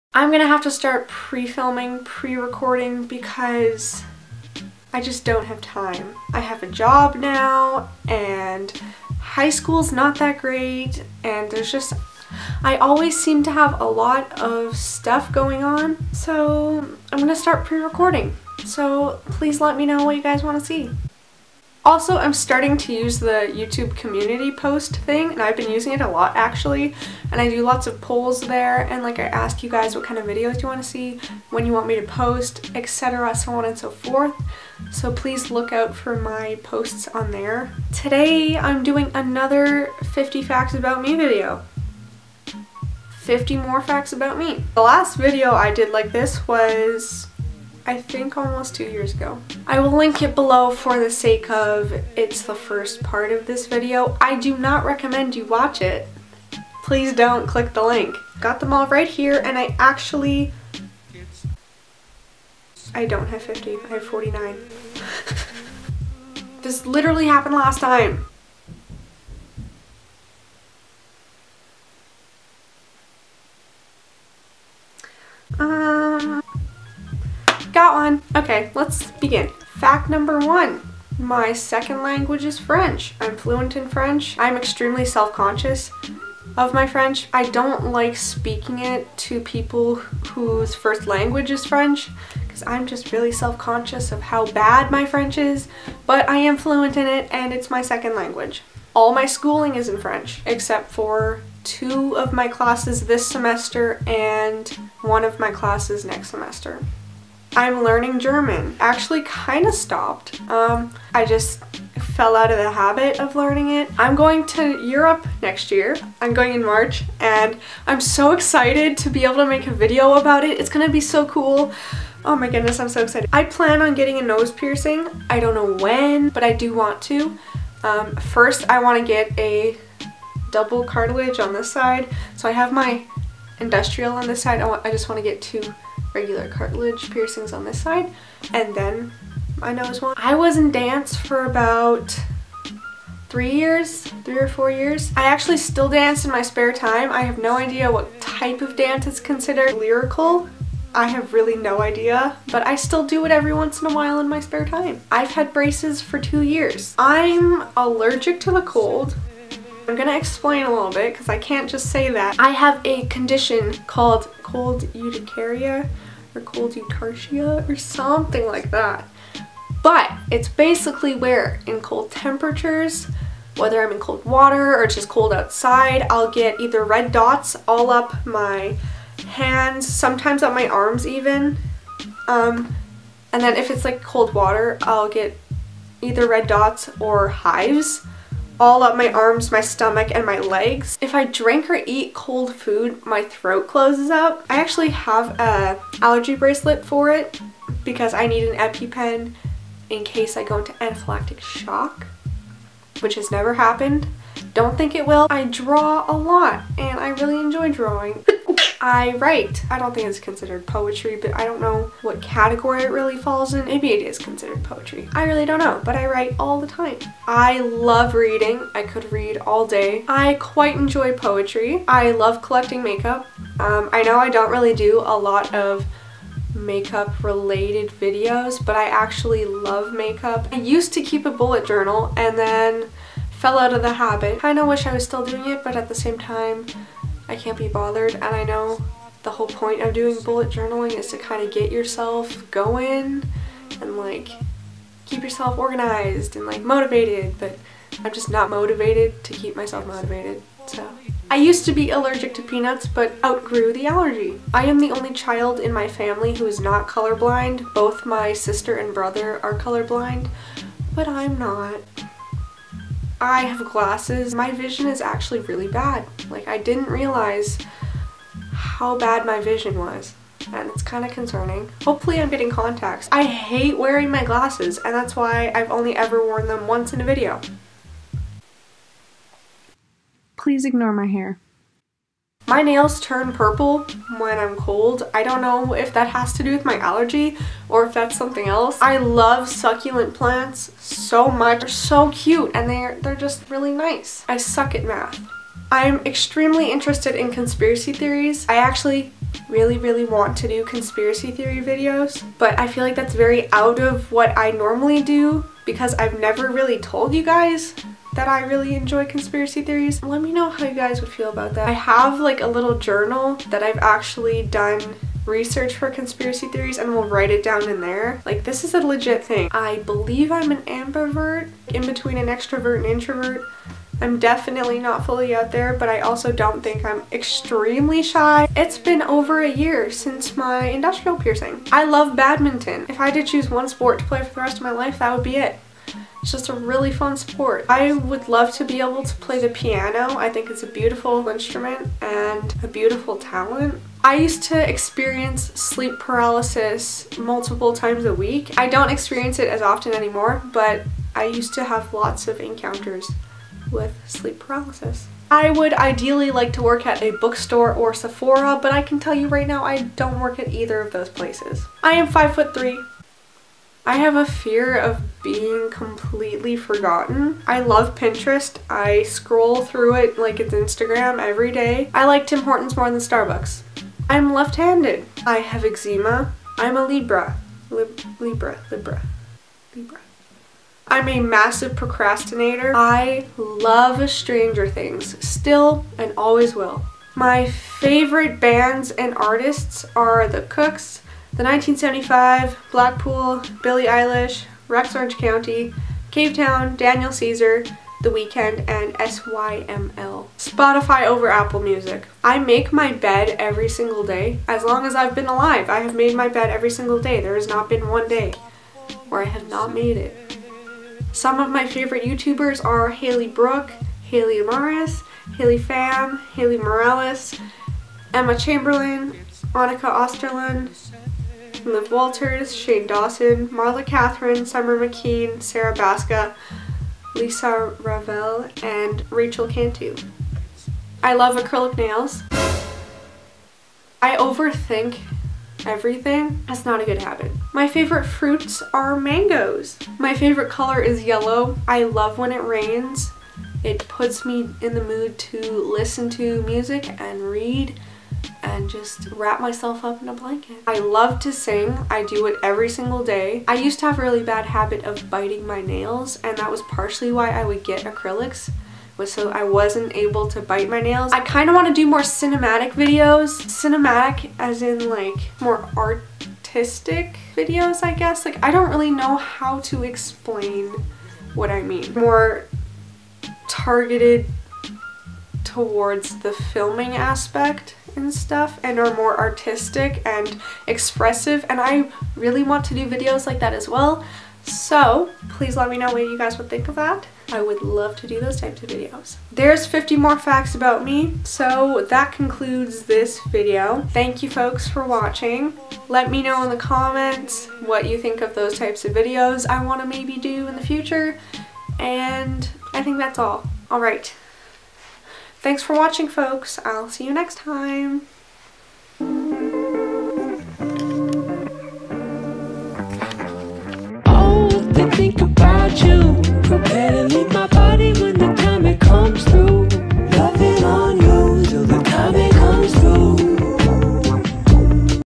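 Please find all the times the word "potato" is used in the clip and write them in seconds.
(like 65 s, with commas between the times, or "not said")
not said.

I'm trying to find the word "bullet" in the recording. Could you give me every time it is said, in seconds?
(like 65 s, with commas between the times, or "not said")
231 s, 240 s.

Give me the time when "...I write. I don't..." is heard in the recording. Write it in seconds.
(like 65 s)
208 s.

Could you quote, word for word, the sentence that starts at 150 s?
I have really no idea, but I still do it every once in a while in my spare time.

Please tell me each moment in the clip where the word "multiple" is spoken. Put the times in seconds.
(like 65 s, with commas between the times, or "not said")
347 s.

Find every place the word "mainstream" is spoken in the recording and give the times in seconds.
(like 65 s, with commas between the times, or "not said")
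not said.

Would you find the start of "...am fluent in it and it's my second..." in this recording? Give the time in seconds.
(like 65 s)
96 s.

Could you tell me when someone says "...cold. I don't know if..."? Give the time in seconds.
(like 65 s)
284 s.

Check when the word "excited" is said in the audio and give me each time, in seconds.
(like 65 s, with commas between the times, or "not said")
118 s, 123 s.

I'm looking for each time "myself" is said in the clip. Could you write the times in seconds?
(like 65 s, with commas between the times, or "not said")
249 s, 449 s.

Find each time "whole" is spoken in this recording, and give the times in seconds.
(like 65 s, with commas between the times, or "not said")
239 s.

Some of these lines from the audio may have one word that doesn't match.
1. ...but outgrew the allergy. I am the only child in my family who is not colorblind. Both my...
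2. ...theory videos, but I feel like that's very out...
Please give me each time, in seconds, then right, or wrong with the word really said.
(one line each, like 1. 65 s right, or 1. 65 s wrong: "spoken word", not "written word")
1. 252 s right
2. 301 s right.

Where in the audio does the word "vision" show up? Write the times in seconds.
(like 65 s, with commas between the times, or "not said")
264 s, 269 s.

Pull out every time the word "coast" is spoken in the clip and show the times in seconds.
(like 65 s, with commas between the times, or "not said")
not said.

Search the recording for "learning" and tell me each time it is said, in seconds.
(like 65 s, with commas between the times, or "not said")
107 s, 113 s.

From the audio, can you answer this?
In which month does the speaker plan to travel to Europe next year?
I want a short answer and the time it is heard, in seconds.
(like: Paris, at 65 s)
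March, at 116 s.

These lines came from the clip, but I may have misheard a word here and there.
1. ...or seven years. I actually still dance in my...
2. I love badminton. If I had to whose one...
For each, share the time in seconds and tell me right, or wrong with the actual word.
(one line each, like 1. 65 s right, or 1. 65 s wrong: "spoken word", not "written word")
1. 144 s wrong: "four", not "seven"
2. 331 s wrong: "choose", not "whose".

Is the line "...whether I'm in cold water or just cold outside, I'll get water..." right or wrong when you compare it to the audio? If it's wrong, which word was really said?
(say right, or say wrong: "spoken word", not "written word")
wrong: "either", not "water".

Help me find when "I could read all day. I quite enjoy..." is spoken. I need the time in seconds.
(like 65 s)
218 s.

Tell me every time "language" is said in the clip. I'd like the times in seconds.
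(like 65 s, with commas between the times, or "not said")
82 s, 91 s, 98 s.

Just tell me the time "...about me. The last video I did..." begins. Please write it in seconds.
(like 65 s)
44 s.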